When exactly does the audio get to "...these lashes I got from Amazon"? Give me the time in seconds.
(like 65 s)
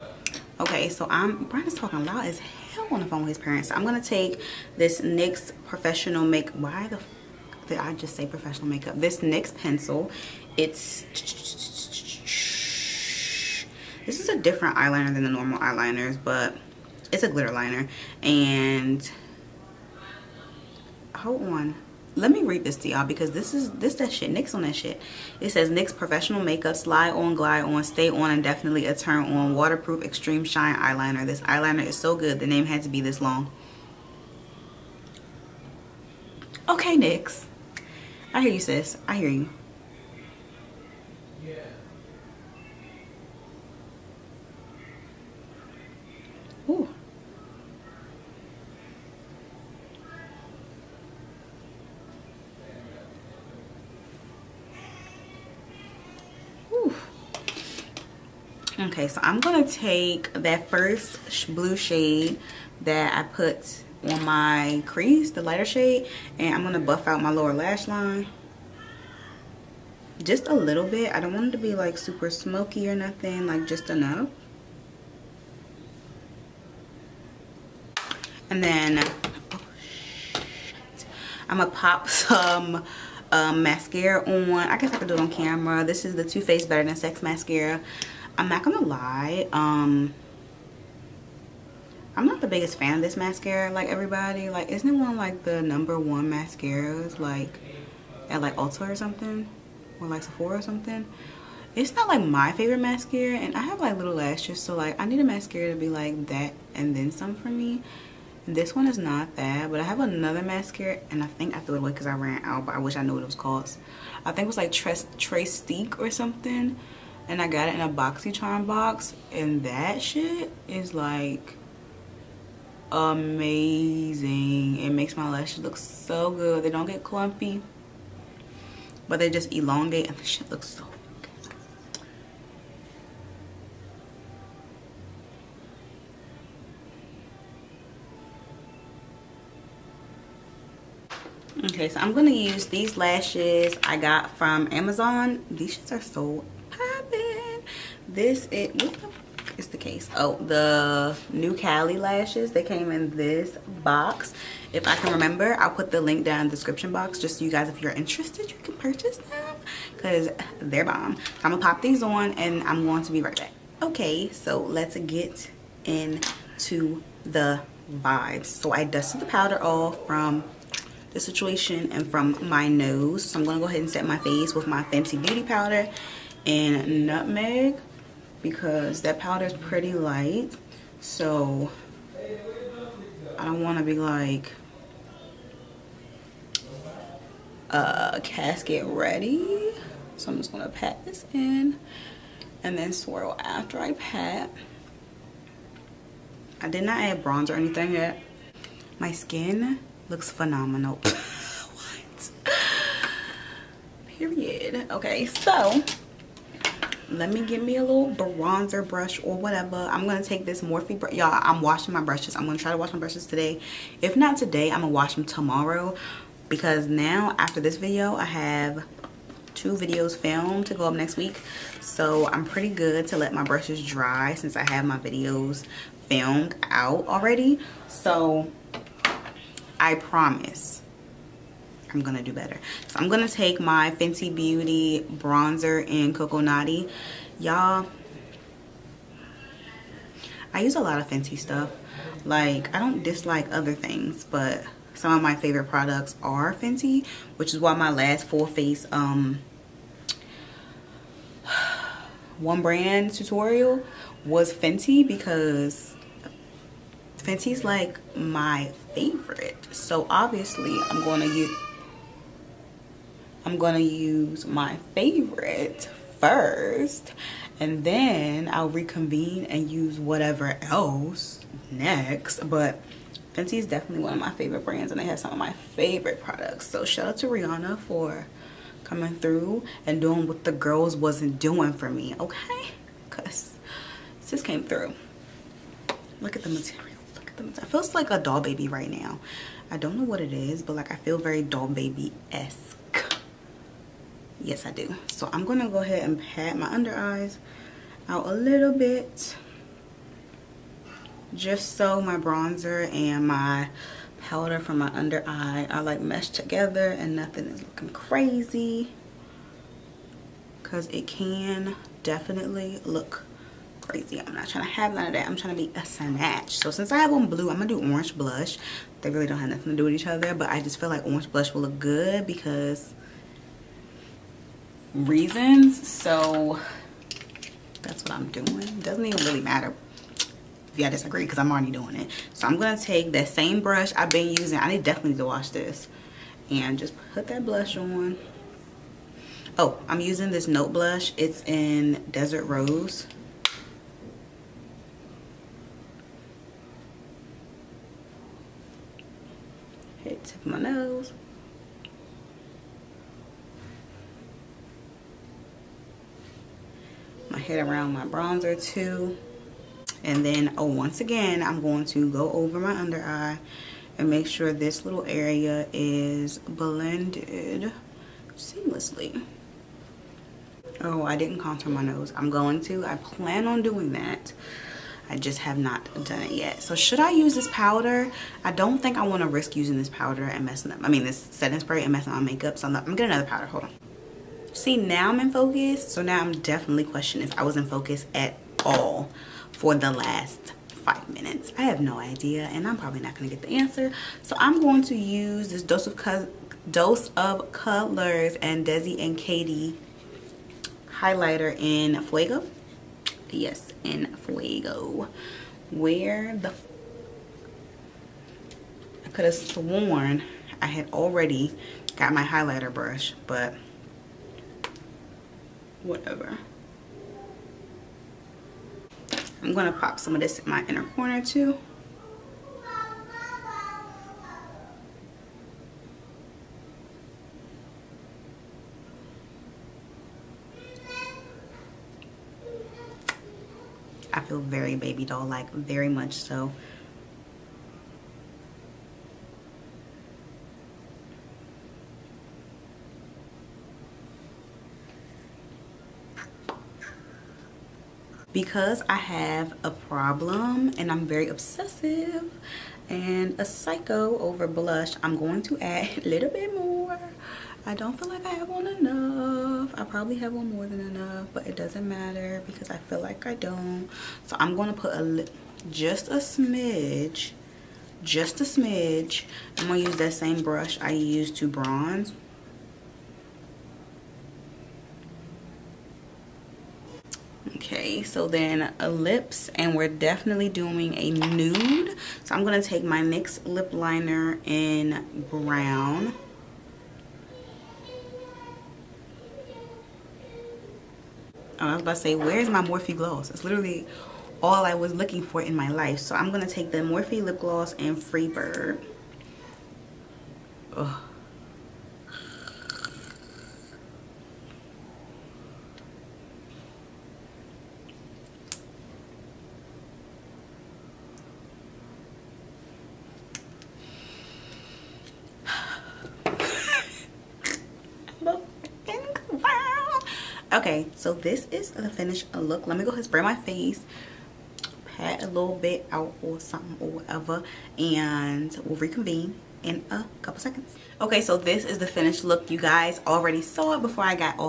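142 s.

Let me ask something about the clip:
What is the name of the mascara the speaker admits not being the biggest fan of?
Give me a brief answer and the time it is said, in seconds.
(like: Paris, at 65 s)
Too Faced Better Than Sex, at 86 s.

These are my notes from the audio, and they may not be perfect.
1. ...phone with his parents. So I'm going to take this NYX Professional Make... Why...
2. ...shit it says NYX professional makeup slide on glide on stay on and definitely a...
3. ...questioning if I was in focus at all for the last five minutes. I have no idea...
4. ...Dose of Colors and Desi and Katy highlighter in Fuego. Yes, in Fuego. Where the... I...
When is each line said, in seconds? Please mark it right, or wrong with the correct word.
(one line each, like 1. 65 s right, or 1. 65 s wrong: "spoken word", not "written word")
1. 3 s right
2. 24 s right
3. 386 s right
4. 396 s right.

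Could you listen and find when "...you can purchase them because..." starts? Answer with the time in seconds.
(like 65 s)
158 s.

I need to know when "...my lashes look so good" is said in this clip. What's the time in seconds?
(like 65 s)
125 s.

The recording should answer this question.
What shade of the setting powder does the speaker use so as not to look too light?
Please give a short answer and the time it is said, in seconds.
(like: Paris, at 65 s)
Nutmeg, at 177 s.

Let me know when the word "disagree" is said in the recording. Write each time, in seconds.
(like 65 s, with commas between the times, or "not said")
330 s.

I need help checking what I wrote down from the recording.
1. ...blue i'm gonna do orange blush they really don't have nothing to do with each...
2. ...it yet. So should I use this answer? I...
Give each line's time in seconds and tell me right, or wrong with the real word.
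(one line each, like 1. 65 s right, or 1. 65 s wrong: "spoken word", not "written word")
1. 317 s right
2. 376 s wrong: "powder", not "answer".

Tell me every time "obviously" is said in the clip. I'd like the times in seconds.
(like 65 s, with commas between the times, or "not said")
260 s.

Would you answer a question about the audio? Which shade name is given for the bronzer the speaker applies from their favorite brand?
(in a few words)
Coco.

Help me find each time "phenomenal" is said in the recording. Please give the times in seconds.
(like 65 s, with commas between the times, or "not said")
200 s.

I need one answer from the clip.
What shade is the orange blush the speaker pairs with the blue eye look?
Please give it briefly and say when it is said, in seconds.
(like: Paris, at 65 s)
Desert Rose, at 342 s.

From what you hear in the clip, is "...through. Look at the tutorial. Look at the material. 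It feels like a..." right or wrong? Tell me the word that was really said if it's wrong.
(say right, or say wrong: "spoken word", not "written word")
wrong: "material", not "tutorial".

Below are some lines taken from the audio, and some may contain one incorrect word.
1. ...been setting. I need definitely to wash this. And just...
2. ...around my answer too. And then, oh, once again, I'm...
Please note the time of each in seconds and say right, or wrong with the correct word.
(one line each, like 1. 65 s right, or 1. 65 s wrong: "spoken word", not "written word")
1. 334 s wrong: "using", not "setting"
2. 357 s wrong: "bronzer", not "answer".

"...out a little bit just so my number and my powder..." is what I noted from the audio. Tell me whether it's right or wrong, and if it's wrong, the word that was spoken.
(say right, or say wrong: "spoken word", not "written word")
wrong: "bronzer", not "number".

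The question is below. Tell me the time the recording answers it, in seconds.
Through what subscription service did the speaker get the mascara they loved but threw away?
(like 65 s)
117 s.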